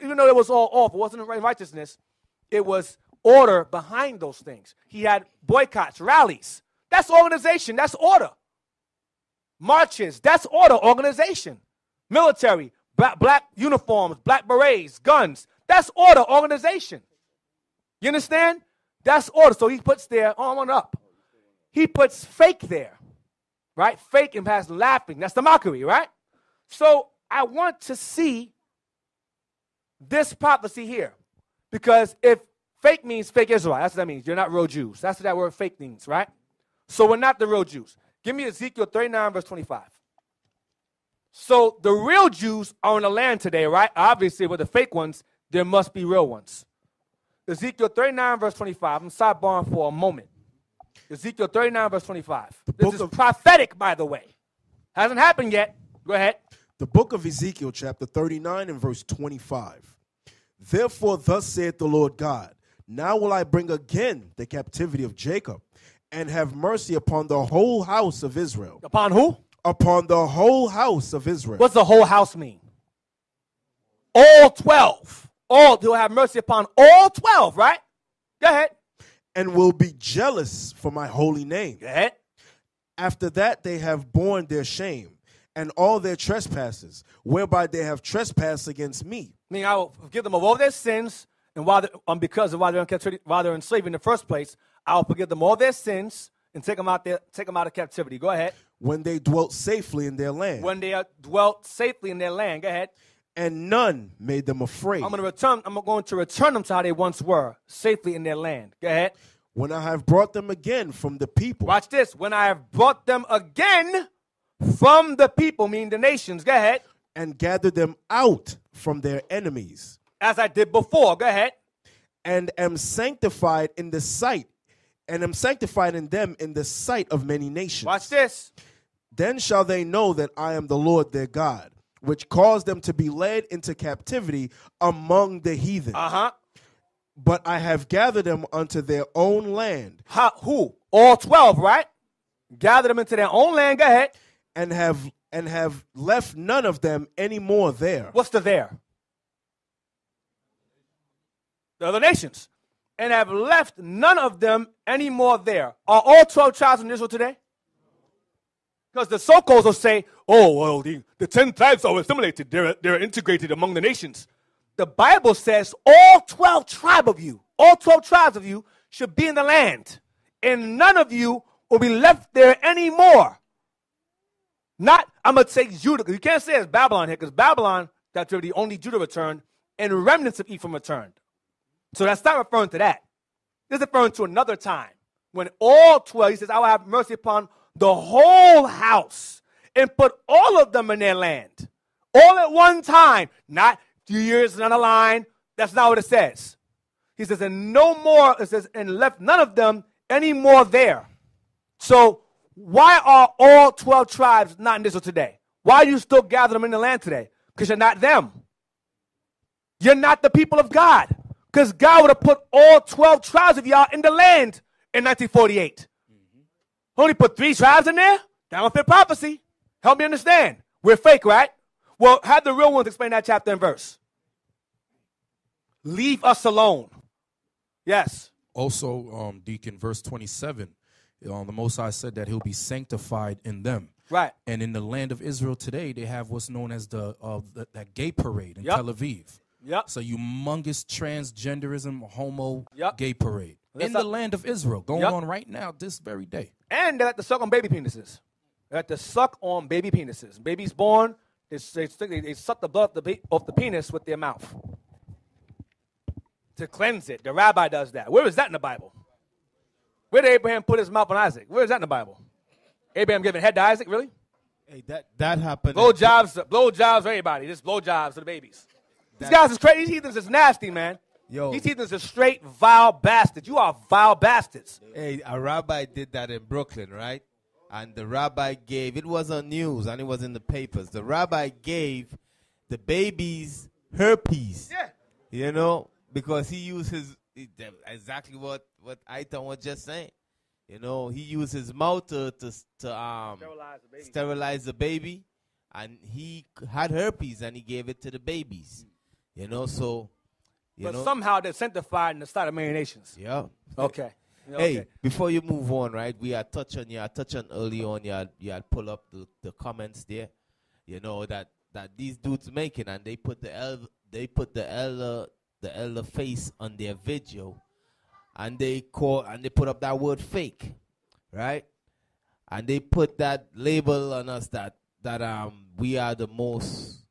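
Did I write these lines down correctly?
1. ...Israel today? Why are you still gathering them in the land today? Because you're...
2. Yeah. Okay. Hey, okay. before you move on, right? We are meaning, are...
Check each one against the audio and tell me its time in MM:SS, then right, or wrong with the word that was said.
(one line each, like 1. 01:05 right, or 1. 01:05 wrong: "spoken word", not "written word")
1. 03:24 right
2. 05:03 wrong: "touching", not "meaning".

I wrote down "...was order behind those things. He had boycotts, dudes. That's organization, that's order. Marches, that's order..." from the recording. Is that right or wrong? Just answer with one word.
wrong.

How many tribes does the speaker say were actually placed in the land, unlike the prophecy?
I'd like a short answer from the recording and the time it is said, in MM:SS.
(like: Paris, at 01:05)
3, at 03:37.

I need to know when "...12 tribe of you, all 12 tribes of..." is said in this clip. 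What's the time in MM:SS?
02:46.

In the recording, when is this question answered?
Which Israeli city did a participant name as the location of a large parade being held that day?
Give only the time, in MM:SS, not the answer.
03:58.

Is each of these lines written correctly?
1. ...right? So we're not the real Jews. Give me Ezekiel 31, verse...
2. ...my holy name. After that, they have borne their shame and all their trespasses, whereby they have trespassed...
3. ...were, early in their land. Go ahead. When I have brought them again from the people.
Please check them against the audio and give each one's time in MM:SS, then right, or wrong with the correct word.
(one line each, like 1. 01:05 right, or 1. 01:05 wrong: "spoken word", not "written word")
1. 00:36 wrong: "39", not "31"
2. 01:20 right
3. 01:47 wrong: "safely", not "early".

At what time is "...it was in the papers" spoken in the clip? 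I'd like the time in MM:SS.
04:39.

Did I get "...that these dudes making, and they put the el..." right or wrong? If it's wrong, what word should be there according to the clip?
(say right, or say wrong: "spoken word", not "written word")
right.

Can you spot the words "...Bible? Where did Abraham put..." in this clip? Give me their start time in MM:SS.
04:18.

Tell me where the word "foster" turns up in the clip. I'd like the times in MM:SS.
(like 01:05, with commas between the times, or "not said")
not said.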